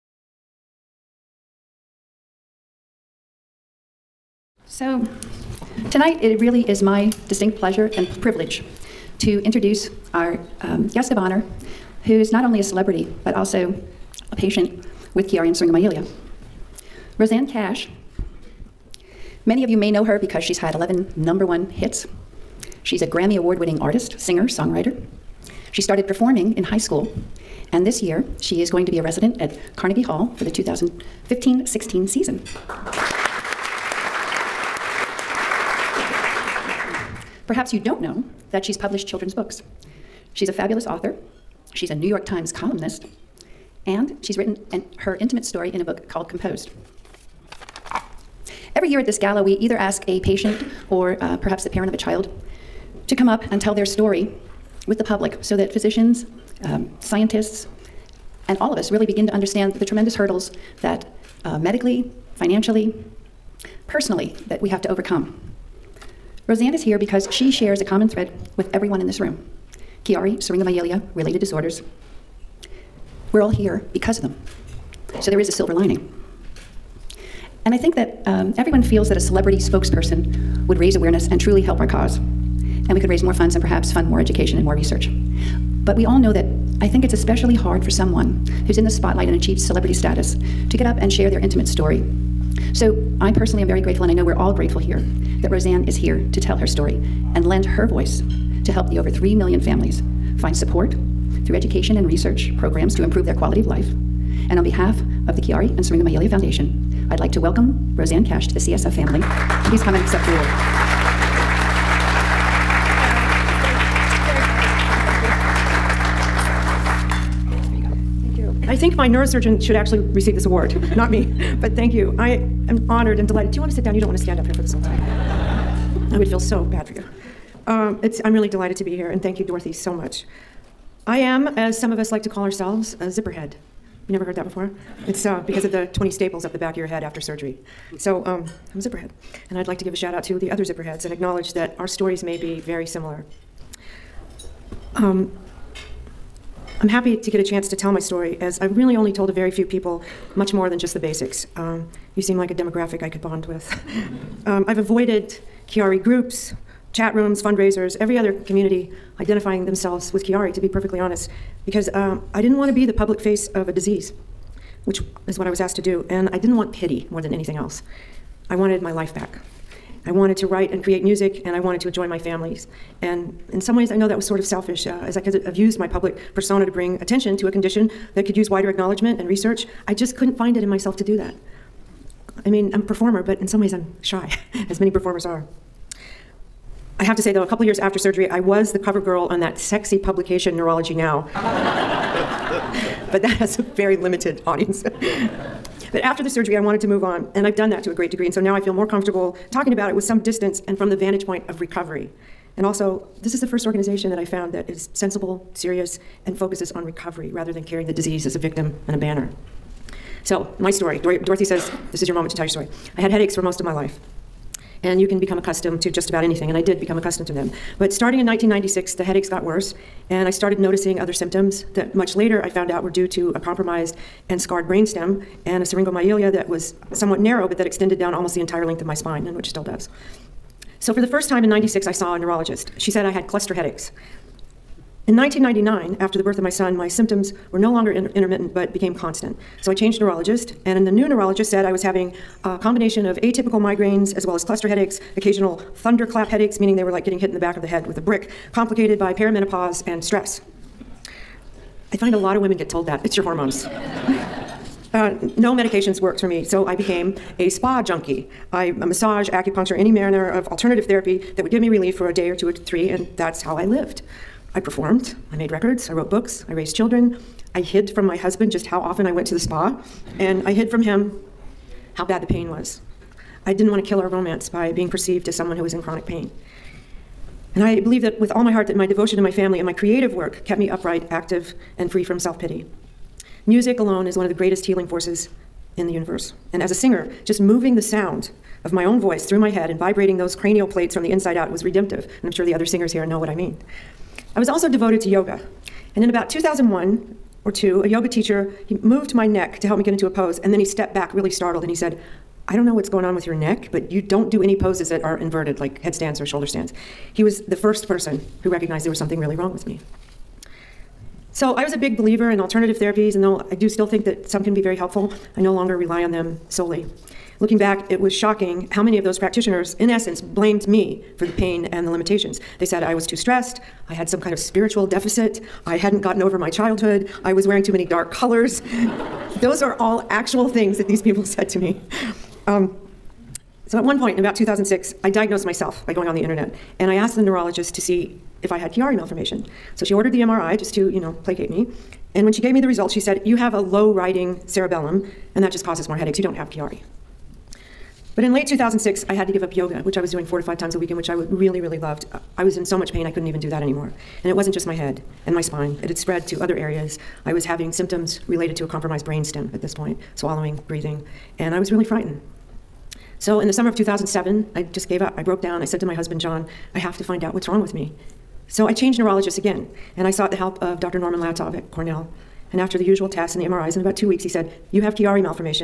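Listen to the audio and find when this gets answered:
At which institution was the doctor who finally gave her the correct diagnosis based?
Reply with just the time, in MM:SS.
06:11.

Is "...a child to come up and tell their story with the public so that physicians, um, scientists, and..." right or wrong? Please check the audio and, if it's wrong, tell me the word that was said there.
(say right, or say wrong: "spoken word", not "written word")
right.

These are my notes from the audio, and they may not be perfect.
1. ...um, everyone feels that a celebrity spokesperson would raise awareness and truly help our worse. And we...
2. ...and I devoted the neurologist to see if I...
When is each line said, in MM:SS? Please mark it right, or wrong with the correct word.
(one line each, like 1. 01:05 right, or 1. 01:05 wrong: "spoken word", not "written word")
1. 01:18 wrong: "cause", not "worse"
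2. 05:36 wrong: "asked", not "devoted".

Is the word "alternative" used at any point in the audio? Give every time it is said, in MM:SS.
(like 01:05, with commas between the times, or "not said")
04:20, 05:12.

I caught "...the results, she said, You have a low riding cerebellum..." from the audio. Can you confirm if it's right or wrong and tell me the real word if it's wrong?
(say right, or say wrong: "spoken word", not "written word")
right.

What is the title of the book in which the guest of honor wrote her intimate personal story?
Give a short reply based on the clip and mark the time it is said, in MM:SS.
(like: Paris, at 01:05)
Composed, at 00:46.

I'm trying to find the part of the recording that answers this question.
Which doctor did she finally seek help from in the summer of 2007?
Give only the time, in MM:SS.
06:10.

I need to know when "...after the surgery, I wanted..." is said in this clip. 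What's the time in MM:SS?
03:16.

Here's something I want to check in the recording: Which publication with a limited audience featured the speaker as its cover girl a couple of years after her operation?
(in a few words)
Neurology Now.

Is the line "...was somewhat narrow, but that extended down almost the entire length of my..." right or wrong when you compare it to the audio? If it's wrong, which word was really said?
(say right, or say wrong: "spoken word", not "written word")
right.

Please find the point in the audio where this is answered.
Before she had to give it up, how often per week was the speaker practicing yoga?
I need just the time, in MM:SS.
05:50.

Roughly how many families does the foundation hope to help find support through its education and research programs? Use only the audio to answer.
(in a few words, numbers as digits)
3 million.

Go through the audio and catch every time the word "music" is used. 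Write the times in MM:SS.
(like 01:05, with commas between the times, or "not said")
02:51, 04:43.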